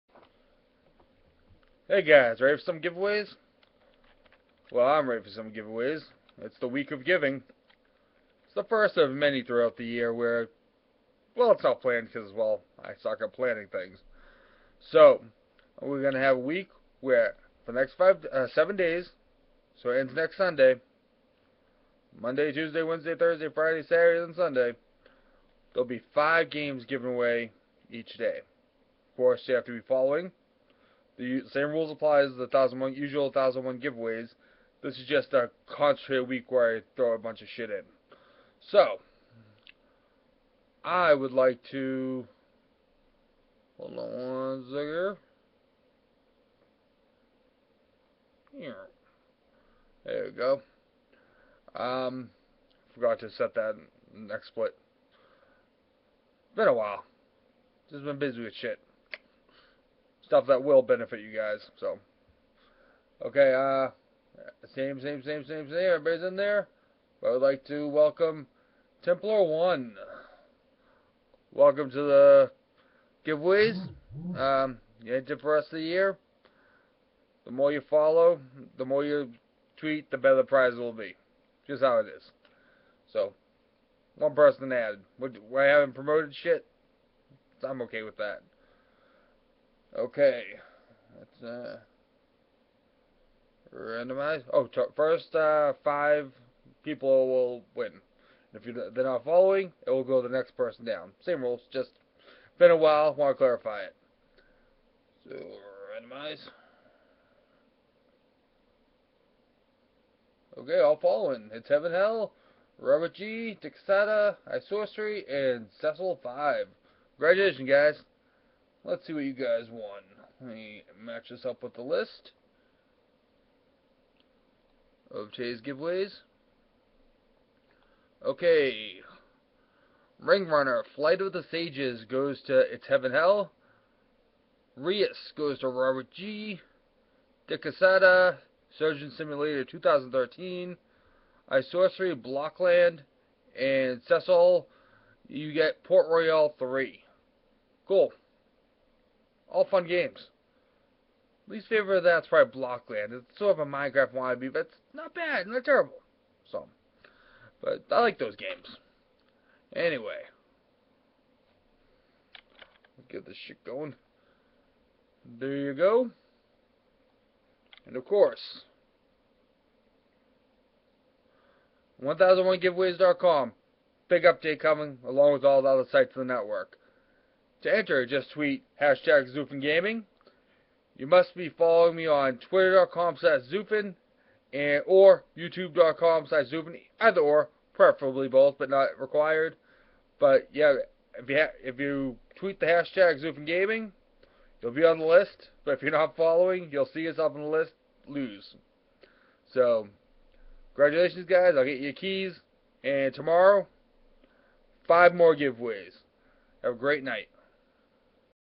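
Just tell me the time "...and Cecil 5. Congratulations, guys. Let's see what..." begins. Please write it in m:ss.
1:55.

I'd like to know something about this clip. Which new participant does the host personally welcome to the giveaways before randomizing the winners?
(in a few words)
Templar One.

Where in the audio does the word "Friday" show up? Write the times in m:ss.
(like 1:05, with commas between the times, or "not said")
0:23.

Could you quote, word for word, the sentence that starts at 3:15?
But if you're not following, you'll see yourself on the list, lose.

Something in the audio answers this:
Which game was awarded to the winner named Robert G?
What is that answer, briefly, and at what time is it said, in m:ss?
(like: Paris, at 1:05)
Reus, at 2:14.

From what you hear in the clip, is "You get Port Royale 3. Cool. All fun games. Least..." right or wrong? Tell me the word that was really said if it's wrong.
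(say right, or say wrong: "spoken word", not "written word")
right.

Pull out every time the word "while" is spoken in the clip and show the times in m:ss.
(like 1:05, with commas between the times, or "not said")
0:56, 1:42.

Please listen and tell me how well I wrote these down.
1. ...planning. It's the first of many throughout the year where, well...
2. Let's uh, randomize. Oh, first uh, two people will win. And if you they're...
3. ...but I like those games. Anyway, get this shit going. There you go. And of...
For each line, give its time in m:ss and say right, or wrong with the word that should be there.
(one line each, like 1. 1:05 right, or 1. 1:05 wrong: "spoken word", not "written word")
1. 0:07 wrong: "giving", not "planning"
2. 1:31 wrong: "five", not "two"
3. 2:37 right.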